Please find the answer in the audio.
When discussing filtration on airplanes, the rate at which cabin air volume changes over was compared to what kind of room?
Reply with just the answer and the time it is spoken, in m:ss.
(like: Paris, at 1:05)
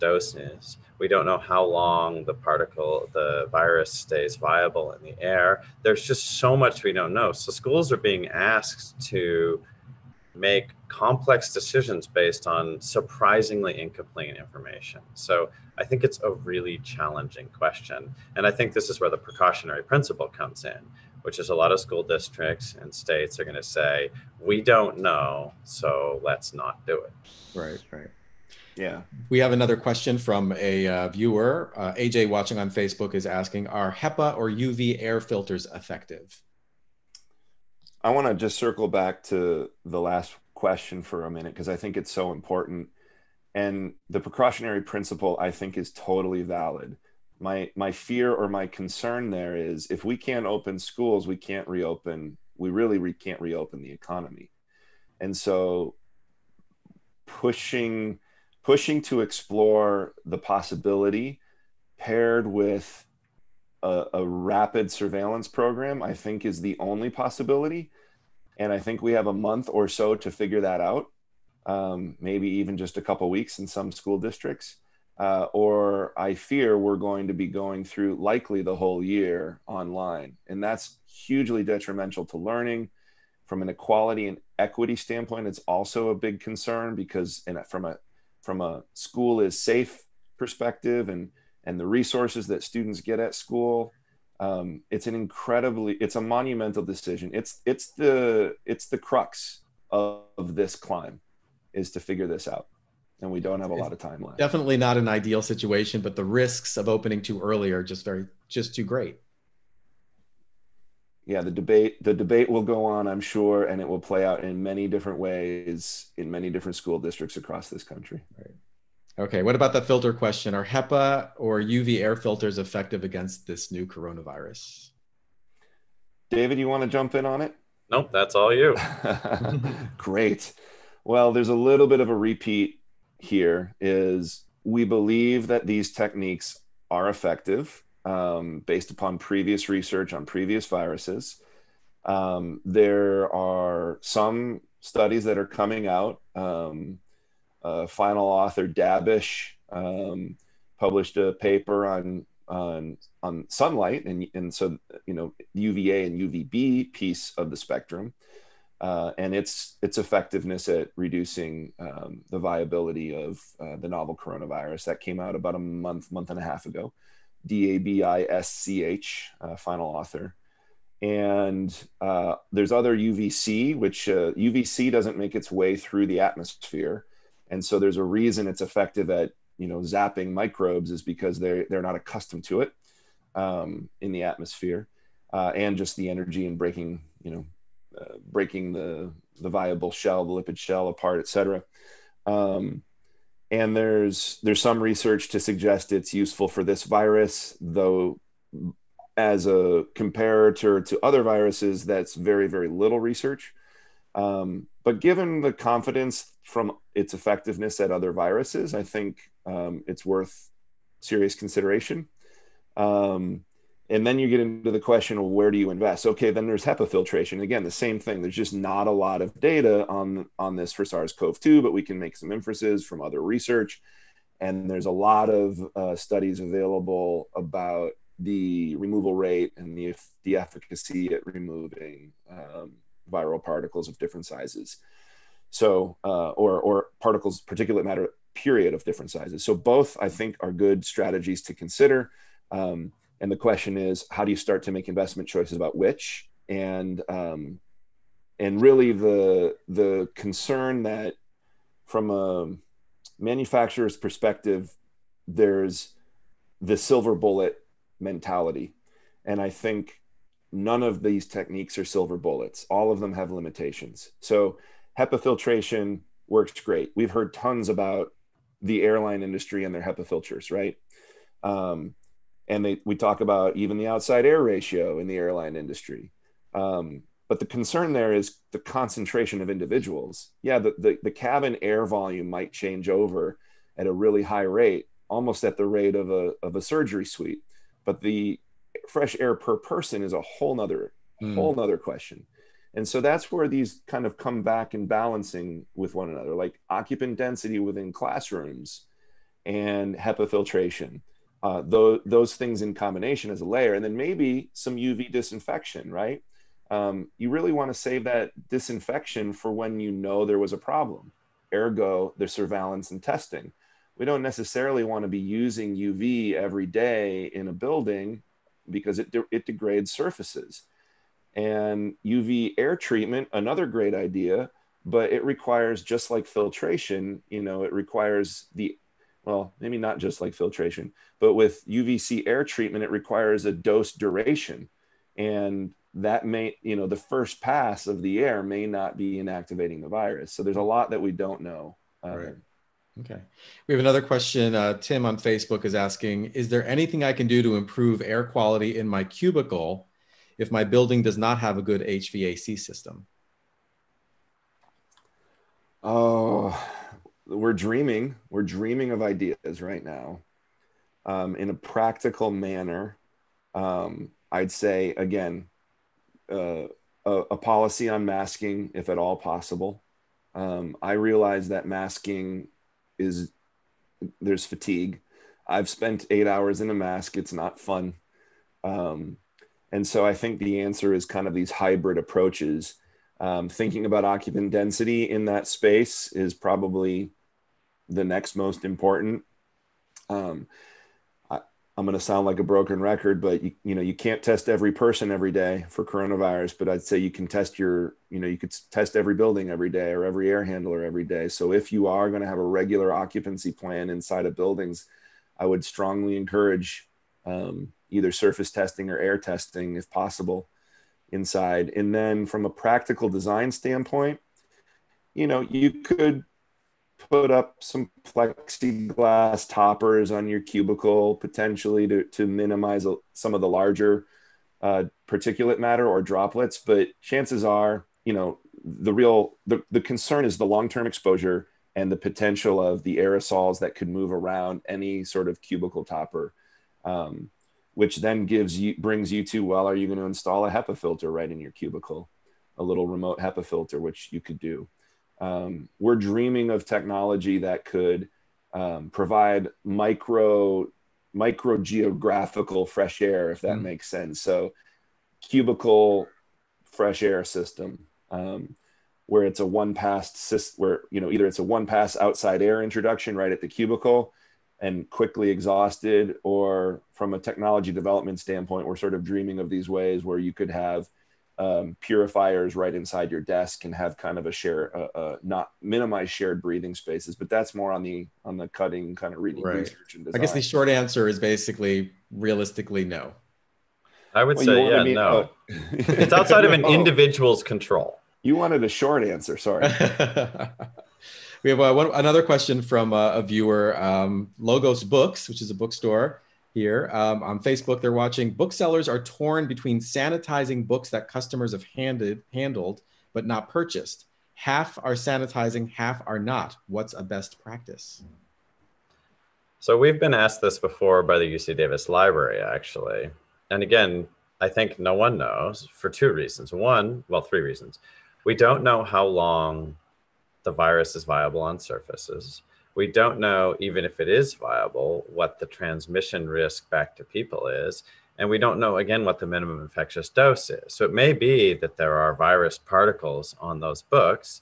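a surgery suite, at 4:46.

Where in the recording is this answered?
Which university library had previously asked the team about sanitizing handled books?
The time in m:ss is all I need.
8:31.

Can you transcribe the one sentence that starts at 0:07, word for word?
So schools are being asked to make complex decisions based on surprisingly incomplete information.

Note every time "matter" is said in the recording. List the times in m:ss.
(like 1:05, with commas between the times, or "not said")
3:57, 7:05.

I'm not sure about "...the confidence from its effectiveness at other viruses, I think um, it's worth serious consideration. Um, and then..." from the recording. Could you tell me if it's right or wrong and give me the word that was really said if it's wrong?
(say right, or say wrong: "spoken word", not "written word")
right.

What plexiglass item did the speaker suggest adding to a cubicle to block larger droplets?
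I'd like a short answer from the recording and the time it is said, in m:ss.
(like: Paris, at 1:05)
toppers, at 6:58.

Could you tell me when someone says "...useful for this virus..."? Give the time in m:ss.
3:16.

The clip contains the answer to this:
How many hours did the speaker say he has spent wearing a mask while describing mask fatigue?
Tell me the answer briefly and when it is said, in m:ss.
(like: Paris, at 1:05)
8, at 6:16.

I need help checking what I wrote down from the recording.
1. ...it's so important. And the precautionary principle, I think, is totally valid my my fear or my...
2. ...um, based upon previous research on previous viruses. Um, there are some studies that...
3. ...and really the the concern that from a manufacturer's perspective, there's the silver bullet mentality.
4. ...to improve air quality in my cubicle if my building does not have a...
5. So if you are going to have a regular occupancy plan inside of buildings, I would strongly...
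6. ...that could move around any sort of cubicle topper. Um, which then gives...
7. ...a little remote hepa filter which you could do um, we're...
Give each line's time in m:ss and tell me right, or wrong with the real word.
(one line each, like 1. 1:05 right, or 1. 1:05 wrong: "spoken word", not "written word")
1. 0:41 right
2. 2:18 right
3. 4:08 right
4. 5:47 right
5. 6:41 right
6. 7:13 right
7. 7:22 right.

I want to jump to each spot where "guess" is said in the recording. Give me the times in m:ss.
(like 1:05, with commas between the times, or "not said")
8:00.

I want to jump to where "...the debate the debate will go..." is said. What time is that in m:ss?
1:51.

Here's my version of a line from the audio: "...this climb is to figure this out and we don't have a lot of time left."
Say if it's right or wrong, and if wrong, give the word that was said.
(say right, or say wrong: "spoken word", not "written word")
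right.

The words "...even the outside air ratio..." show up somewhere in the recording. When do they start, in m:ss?
4:33.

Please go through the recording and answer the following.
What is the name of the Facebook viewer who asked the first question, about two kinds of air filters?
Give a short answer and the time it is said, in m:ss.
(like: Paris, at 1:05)
AJ, at 0:31.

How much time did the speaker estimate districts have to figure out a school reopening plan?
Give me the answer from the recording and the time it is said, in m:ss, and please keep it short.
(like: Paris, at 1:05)
a month or so, at 1:09.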